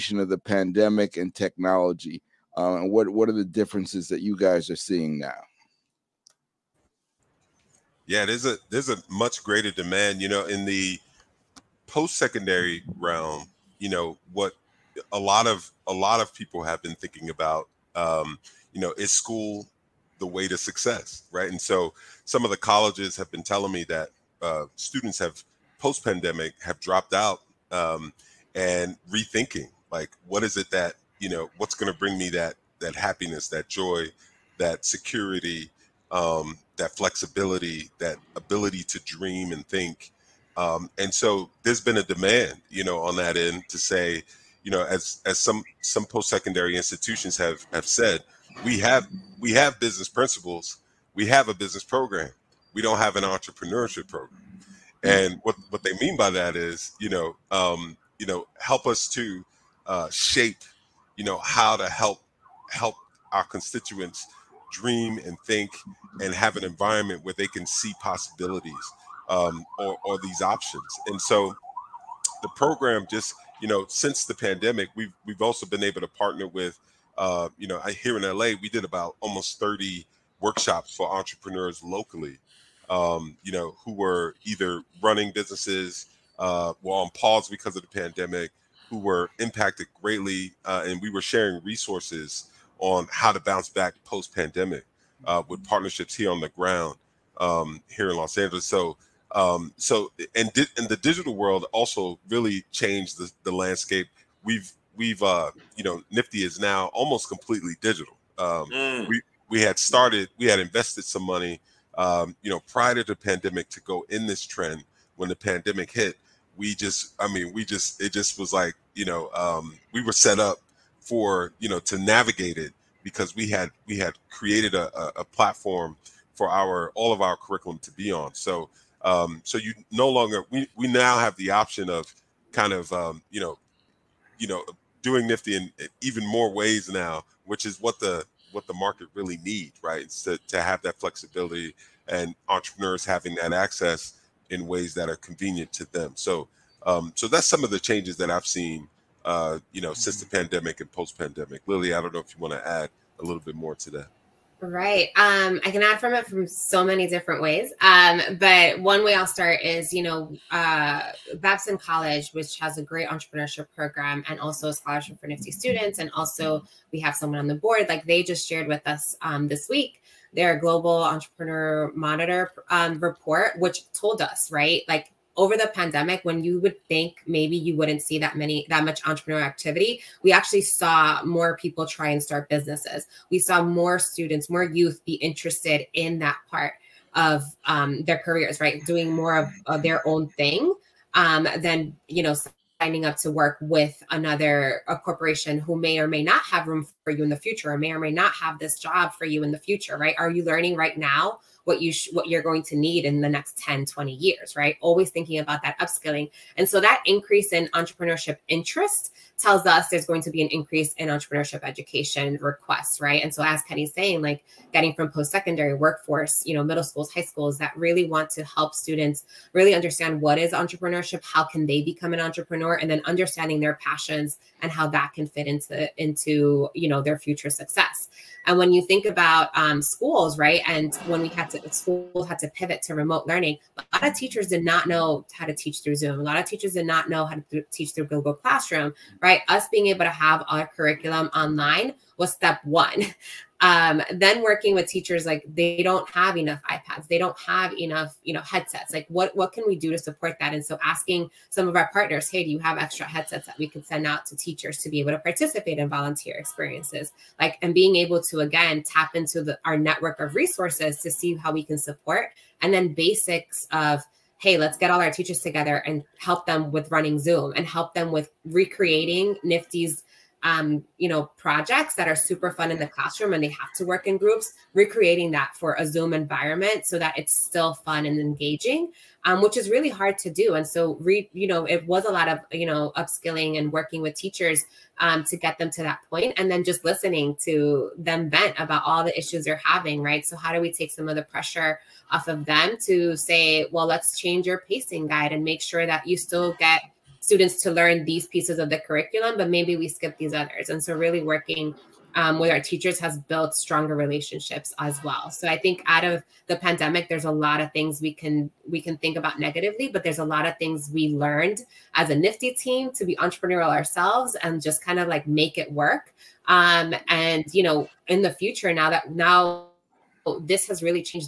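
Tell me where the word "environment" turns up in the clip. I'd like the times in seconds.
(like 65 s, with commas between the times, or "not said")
66 s, 276 s.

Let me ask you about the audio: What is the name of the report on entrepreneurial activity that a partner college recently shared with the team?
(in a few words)
global entrepreneur monitor.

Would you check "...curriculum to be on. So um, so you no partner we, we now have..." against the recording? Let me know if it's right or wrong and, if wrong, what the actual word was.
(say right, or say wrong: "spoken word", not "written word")
wrong: "longer", not "partner".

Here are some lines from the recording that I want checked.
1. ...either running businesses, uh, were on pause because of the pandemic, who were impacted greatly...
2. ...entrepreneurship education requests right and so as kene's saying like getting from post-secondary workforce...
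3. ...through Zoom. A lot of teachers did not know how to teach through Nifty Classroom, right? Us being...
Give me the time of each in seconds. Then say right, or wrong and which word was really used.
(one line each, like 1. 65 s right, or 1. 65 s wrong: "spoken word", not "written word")
1. 84 s right
2. 211 s right
3. 235 s wrong: "Google", not "Nifty".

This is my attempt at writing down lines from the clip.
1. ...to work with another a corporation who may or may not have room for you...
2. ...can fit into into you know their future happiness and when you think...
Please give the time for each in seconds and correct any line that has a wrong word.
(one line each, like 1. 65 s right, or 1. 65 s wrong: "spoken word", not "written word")
1. 193 s right
2. 225 s wrong: "success", not "happiness".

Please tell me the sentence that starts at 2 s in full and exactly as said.
Uh, and what, what are the differences that you guys are seeing now?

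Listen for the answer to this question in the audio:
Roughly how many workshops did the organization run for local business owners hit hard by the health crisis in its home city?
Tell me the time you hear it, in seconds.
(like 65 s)
79 s.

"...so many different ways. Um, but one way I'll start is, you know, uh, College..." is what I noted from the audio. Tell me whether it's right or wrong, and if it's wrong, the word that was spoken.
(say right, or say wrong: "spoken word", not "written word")
wrong: "Babson", not "College".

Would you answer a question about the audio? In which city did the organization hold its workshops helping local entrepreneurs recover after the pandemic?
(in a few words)
Los Angeles.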